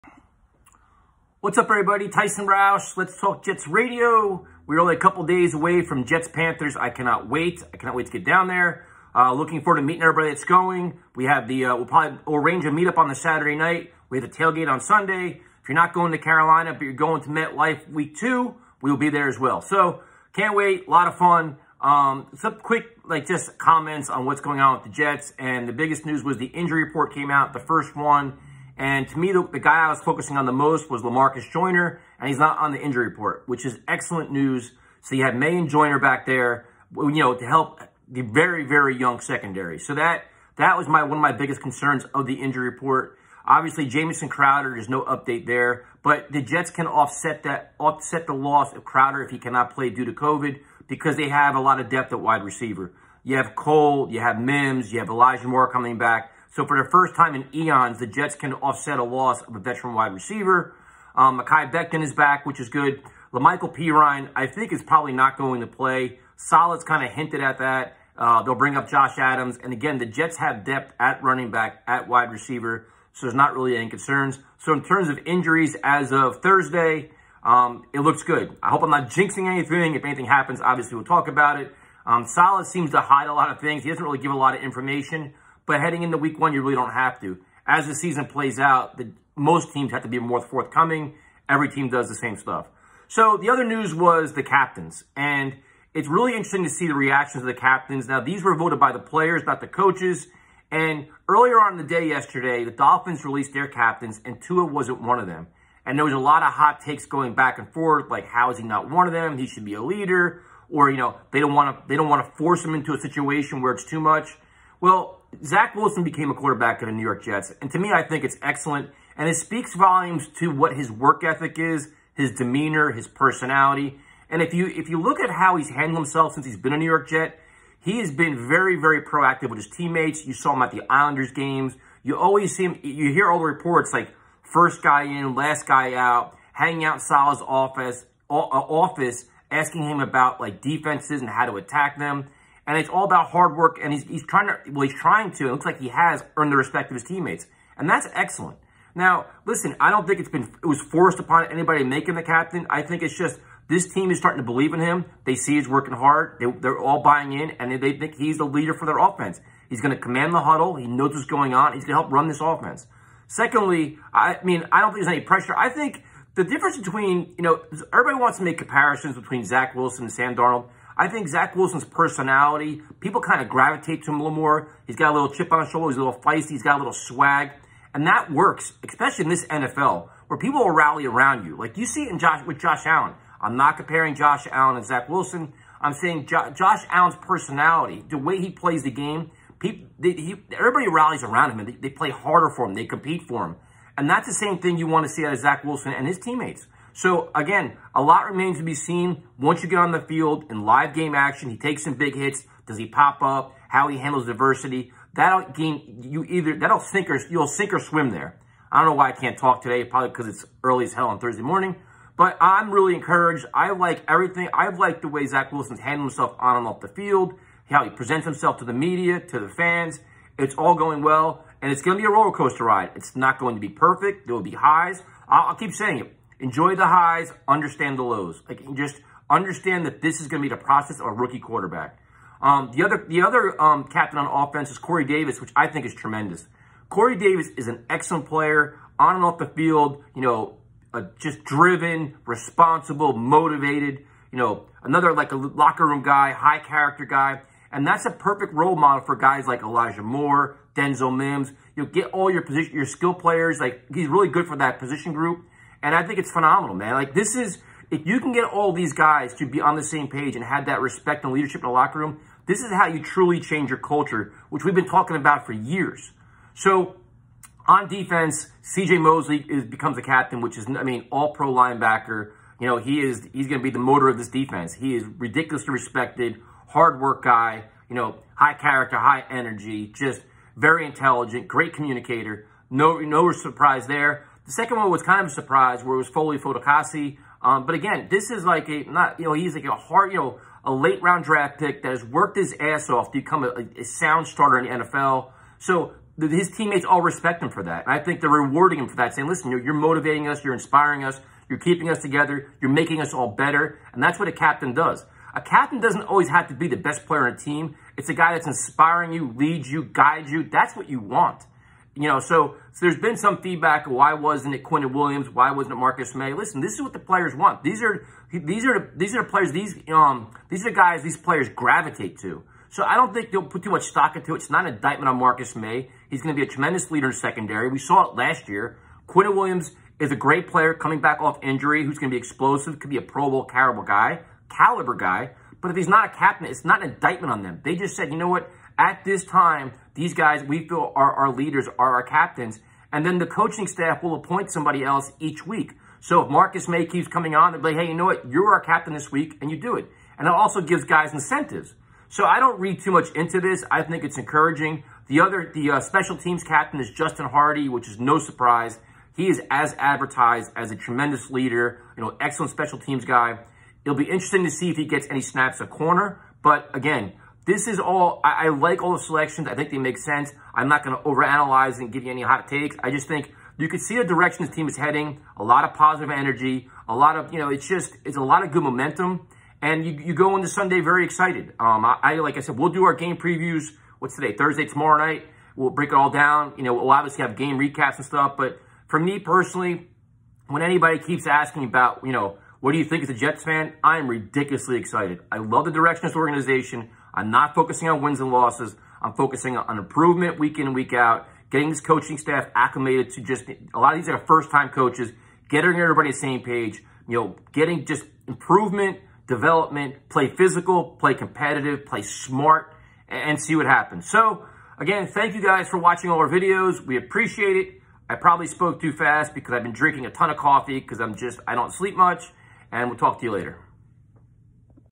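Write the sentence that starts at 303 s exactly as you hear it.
And that's what a captain does.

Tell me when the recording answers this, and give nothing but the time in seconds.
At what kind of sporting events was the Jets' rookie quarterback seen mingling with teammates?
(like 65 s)
130 s.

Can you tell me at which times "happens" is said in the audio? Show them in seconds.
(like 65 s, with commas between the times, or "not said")
80 s, 413 s.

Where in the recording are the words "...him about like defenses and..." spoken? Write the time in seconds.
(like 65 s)
139 s.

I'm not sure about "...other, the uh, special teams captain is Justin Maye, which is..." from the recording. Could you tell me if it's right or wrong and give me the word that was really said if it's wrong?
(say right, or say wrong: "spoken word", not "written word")
wrong: "Hardee", not "Maye".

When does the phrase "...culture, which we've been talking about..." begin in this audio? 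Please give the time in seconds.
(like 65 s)
263 s.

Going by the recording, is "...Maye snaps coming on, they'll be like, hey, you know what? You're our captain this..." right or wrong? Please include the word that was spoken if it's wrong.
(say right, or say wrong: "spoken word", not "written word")
wrong: "keeps", not "snaps".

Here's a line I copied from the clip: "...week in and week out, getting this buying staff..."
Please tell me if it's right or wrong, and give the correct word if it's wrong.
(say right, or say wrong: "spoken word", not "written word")
wrong: "coaching", not "buying".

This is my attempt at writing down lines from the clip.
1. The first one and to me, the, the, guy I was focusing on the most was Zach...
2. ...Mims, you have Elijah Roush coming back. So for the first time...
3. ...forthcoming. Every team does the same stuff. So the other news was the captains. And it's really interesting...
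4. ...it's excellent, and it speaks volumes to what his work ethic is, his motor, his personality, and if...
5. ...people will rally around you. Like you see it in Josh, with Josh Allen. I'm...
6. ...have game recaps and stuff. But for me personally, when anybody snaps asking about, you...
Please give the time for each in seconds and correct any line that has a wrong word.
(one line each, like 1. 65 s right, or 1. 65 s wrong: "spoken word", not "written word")
1. 27 s wrong: "Lamarcus", not "Zach"
2. 54 s wrong: "Moore", not "Roush"
3. 90 s right
4. 118 s wrong: "demeanor", not "motor"
5. 180 s right
6. 387 s wrong: "keeps", not "snaps".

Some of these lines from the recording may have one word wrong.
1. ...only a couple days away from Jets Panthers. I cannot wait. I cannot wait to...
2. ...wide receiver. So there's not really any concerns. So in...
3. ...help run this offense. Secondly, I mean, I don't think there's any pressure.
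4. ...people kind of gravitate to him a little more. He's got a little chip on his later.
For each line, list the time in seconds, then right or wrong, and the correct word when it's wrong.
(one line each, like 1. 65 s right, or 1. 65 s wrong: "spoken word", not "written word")
1. 4 s right
2. 72 s right
3. 162 s right
4. 172 s wrong: "shoulder", not "later".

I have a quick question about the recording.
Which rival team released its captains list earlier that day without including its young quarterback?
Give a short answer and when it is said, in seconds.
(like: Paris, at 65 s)
Dolphins, at 102 s.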